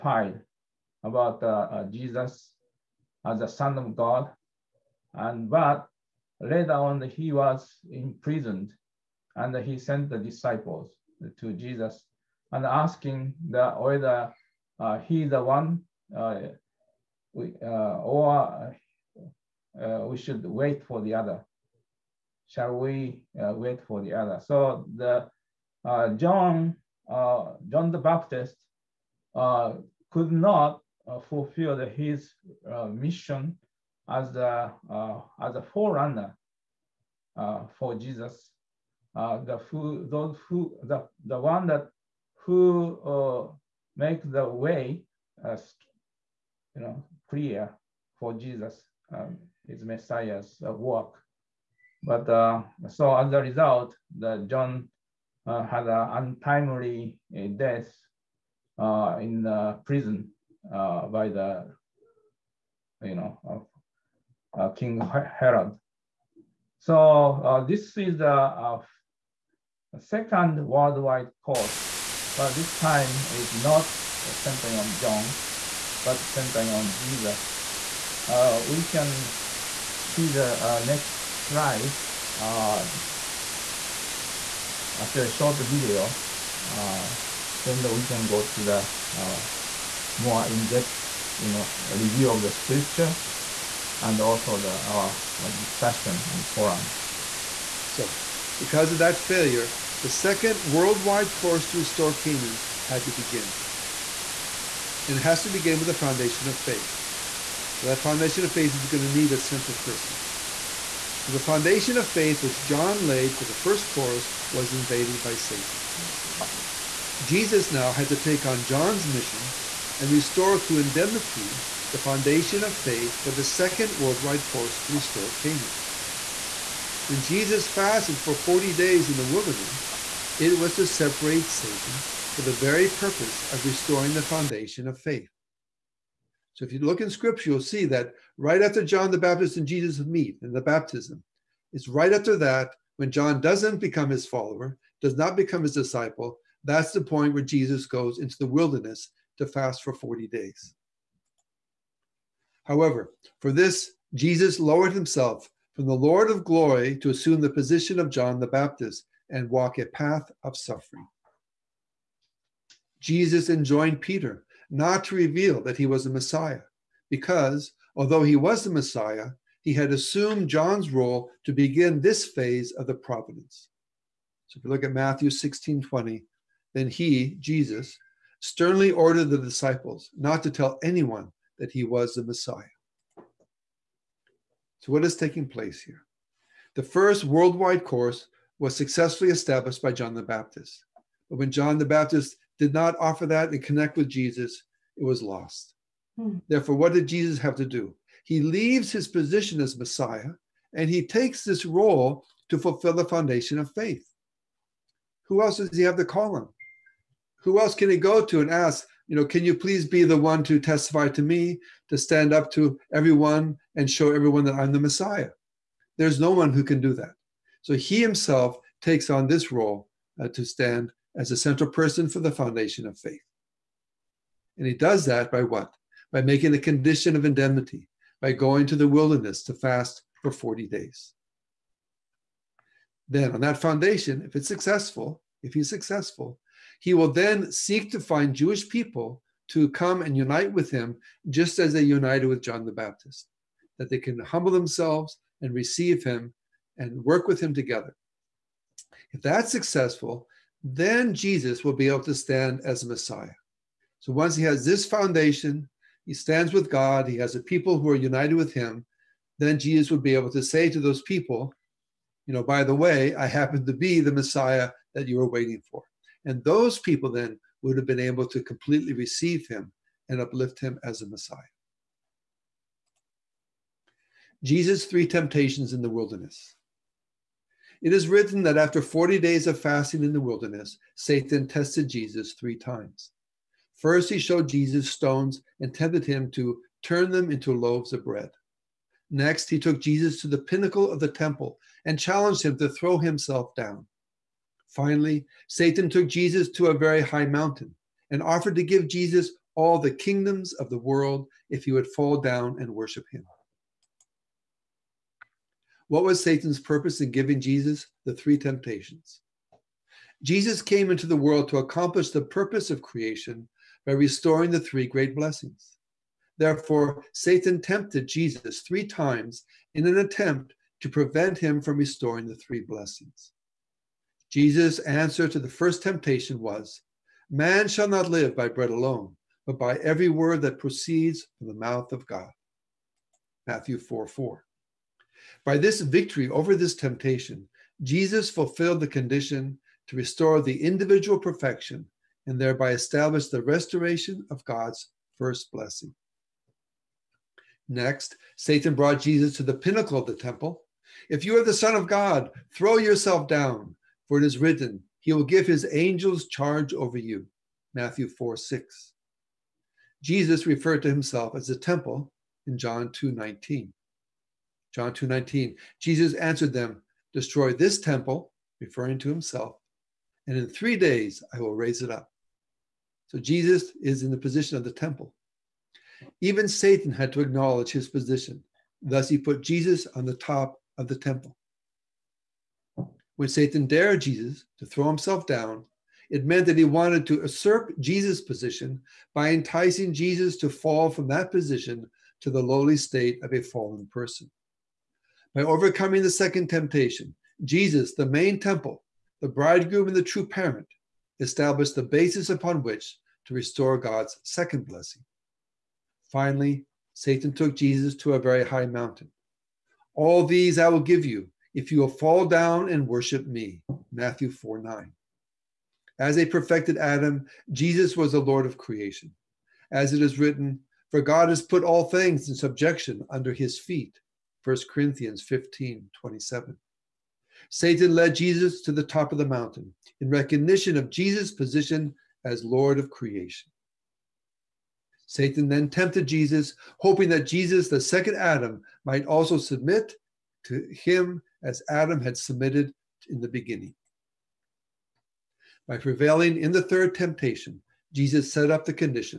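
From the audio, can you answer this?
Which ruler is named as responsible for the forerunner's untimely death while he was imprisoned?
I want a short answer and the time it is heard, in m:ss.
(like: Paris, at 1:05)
King Herod, at 1:04.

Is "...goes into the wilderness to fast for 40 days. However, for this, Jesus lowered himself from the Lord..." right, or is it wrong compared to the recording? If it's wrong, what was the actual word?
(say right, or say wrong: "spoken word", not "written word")
right.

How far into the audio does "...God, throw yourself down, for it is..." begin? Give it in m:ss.
5:51.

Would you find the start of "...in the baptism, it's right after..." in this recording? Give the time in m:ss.
2:20.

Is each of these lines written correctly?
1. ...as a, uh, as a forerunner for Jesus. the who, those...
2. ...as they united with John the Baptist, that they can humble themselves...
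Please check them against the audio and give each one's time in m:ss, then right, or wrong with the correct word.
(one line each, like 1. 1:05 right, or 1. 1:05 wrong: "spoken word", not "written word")
1. 0:34 right
2. 4:01 right.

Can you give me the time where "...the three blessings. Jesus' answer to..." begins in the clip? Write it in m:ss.
5:22.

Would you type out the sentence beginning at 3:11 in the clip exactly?
But when John the Baptist did not offer that and connect with Jesus, it was lost.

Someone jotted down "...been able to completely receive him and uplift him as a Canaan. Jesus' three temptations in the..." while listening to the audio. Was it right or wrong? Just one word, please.
wrong.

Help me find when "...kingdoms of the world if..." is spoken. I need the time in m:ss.
4:59.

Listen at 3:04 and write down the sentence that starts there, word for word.
So, what is taking place here?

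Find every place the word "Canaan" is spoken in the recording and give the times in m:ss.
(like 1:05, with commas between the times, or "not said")
1:42, 2:05.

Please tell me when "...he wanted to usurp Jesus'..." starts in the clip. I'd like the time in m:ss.
6:26.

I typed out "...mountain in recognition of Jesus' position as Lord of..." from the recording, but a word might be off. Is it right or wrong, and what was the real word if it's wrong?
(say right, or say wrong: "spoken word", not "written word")
right.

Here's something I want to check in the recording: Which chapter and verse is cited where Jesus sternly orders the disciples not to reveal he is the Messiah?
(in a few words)
Matthew 16:20.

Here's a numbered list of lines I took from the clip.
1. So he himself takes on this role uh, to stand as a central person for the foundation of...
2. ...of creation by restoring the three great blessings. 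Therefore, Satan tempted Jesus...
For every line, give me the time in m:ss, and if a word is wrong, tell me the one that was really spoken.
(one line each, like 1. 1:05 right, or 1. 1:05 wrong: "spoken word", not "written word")
1. 3:37 right
2. 5:12 right.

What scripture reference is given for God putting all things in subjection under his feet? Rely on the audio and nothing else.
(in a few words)
1 Corinthians 15:27.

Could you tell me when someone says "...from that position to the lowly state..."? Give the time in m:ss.
6:30.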